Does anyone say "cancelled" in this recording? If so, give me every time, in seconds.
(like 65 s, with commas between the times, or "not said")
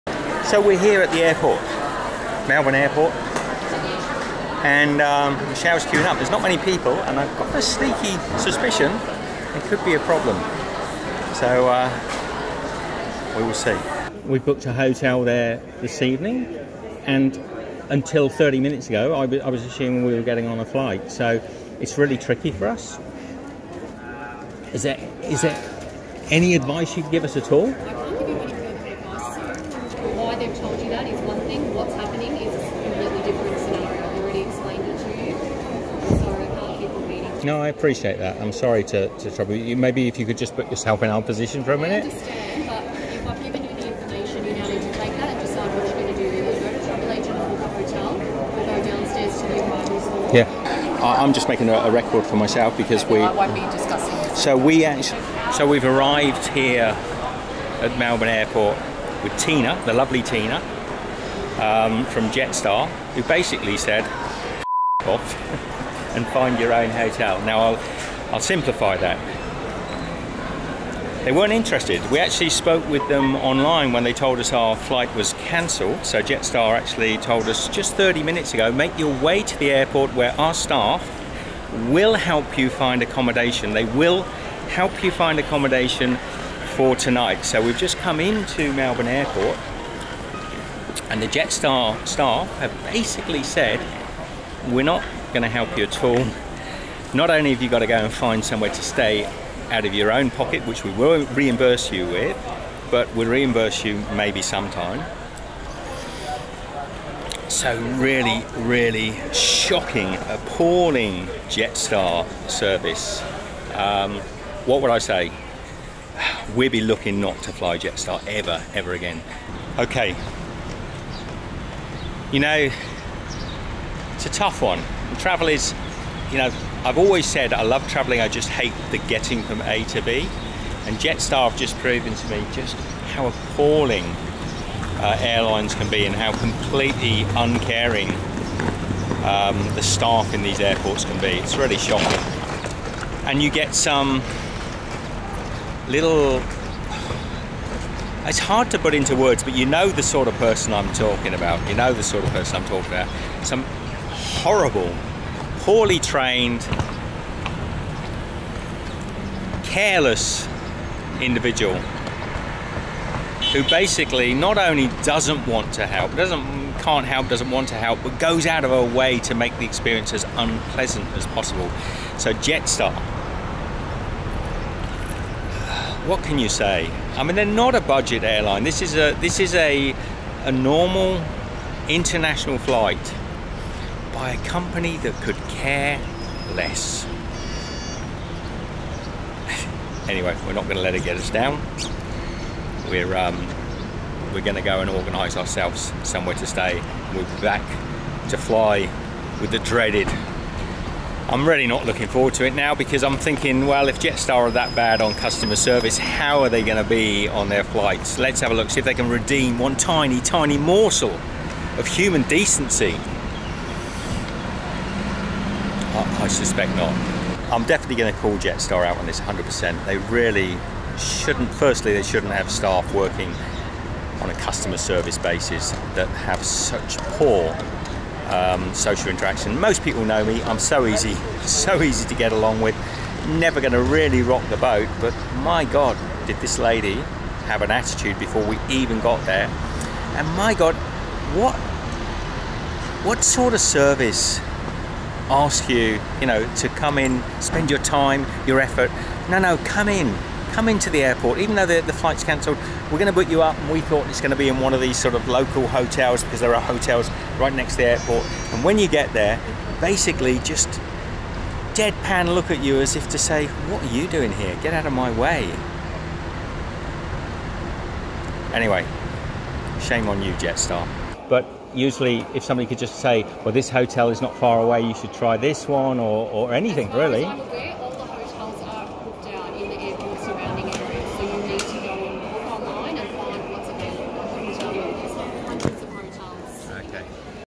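75 s, 252 s.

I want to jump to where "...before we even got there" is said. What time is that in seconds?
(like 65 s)
238 s.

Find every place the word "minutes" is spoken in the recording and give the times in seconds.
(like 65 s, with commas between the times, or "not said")
18 s, 41 s, 78 s.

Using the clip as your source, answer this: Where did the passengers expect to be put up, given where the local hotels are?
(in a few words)
Next to the airport.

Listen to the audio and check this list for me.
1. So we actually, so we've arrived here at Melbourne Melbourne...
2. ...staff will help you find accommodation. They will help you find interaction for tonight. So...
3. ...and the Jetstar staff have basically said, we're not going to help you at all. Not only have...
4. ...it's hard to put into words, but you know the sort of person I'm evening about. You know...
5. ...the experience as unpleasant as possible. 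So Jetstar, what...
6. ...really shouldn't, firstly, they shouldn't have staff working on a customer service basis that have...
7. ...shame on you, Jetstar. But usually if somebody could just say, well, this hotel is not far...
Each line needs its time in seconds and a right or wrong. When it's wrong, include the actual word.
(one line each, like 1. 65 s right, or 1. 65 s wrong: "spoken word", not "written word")
1. 54 s wrong: "Airport", not "Melbourne"
2. 80 s wrong: "accommodation", not "interaction"
3. 91 s right
4. 148 s wrong: "talking", not "evening"
5. 169 s right
6. 219 s right
7. 269 s right.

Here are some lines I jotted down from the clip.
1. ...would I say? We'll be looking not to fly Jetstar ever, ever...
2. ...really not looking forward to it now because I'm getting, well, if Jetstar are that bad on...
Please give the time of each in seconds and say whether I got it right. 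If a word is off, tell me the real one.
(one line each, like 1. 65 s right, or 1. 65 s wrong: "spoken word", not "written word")
1. 114 s right
2. 201 s wrong: "thinking", not "getting".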